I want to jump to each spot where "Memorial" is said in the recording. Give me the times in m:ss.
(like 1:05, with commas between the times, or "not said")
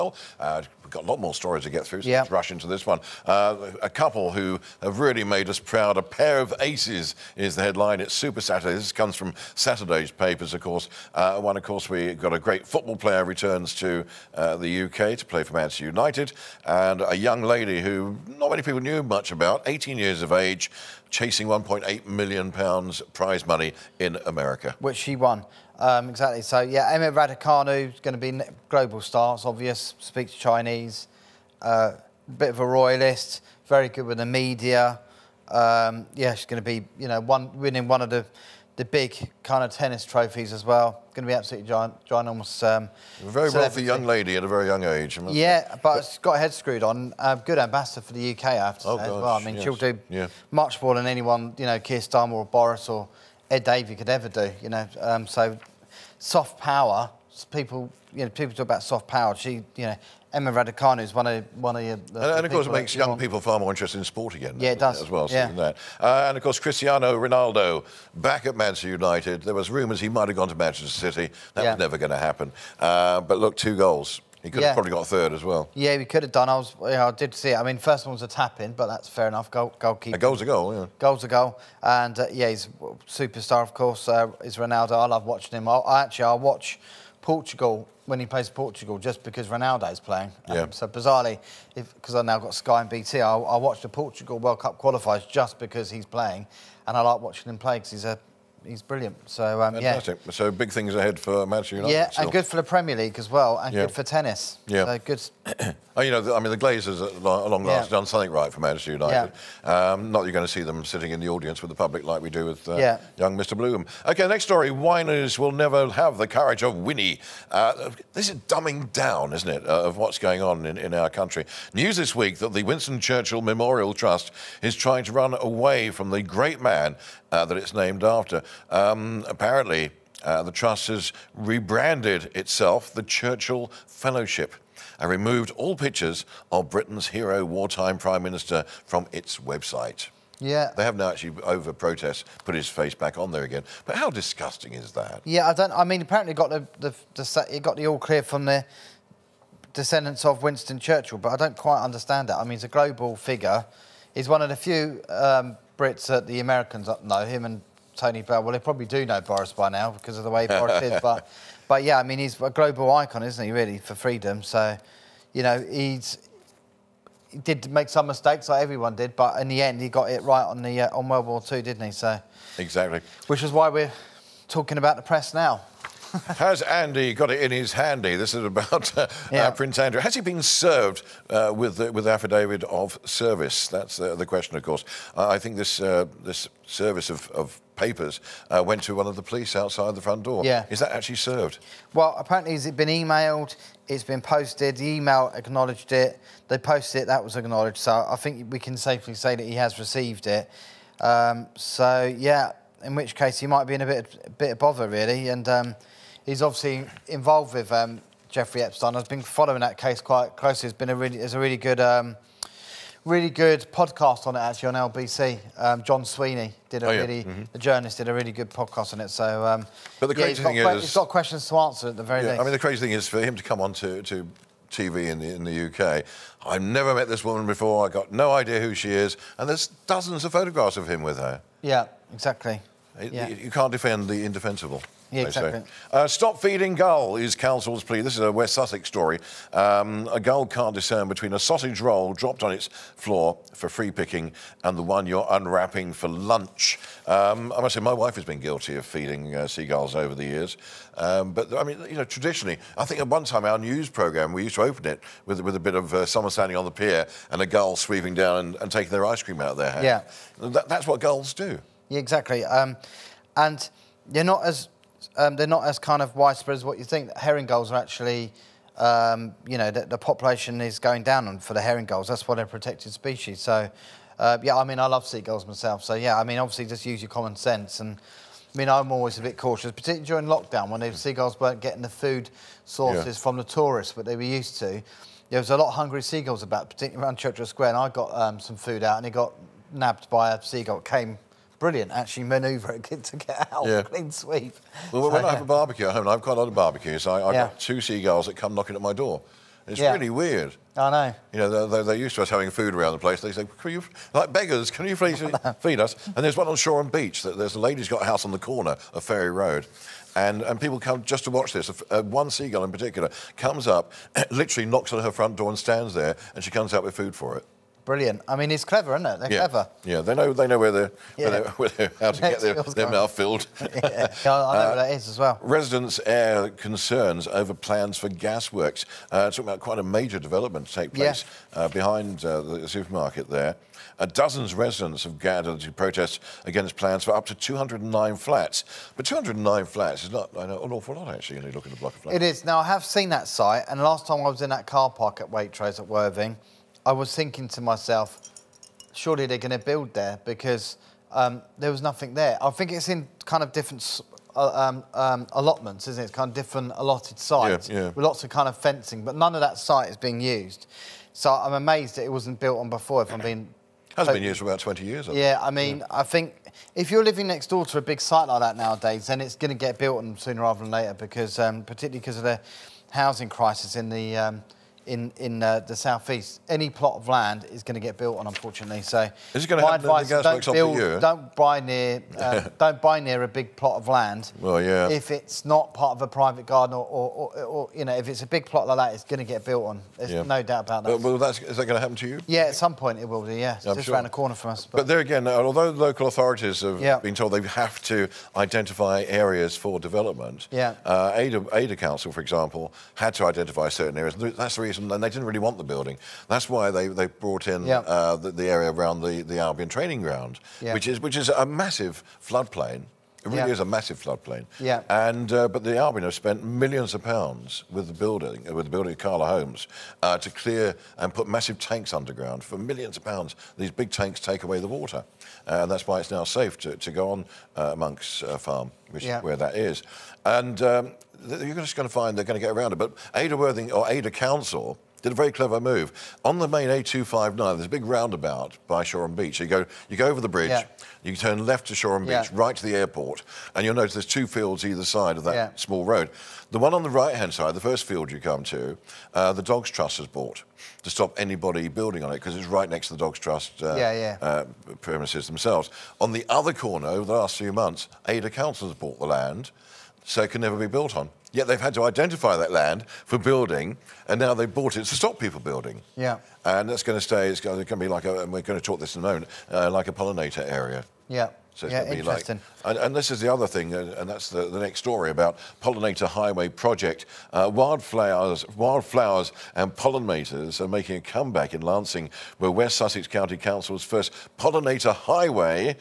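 2:03.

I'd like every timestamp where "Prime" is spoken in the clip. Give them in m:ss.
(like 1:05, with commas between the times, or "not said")
2:17.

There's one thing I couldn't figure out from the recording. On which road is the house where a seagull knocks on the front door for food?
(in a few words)
Ferry Road.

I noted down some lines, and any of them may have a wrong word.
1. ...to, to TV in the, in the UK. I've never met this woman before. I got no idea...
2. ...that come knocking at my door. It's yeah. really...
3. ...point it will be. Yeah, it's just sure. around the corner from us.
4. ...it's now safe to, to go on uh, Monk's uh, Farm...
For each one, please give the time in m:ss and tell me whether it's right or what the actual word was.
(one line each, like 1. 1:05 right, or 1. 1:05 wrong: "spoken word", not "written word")
1. 3:43 right
2. 4:58 right
3. 6:32 right
4. 7:06 right.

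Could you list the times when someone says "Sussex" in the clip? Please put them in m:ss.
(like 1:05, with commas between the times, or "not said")
3:58, 8:02.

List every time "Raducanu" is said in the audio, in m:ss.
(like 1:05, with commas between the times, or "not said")
0:27, 1:00.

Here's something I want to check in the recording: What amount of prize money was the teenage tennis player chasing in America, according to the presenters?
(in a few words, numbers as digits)
1.8 million pounds.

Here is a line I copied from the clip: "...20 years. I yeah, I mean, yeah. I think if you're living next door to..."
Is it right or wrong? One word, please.
right.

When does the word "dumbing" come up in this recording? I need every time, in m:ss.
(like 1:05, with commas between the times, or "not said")
1:58.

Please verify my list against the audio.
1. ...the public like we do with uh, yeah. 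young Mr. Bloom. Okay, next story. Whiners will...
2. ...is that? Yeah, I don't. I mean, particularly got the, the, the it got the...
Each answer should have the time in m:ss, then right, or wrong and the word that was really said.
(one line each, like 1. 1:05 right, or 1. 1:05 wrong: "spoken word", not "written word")
1. 1:51 right
2. 2:24 wrong: "apparently", not "particularly".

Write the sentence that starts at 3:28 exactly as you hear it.
I've been following that case quite closely.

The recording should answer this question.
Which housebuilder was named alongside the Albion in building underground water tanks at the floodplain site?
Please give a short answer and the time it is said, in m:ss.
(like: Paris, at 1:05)
Cala Homes, at 6:58.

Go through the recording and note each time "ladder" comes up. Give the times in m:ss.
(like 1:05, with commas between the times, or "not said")
not said.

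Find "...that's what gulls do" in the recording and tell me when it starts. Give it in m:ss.
4:20.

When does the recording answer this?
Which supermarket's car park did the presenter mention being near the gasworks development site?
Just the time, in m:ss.
5:45.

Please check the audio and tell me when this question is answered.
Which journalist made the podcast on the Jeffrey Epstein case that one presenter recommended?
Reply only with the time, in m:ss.
3:35.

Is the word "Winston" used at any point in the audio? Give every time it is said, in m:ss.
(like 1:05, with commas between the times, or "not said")
2:02, 2:30.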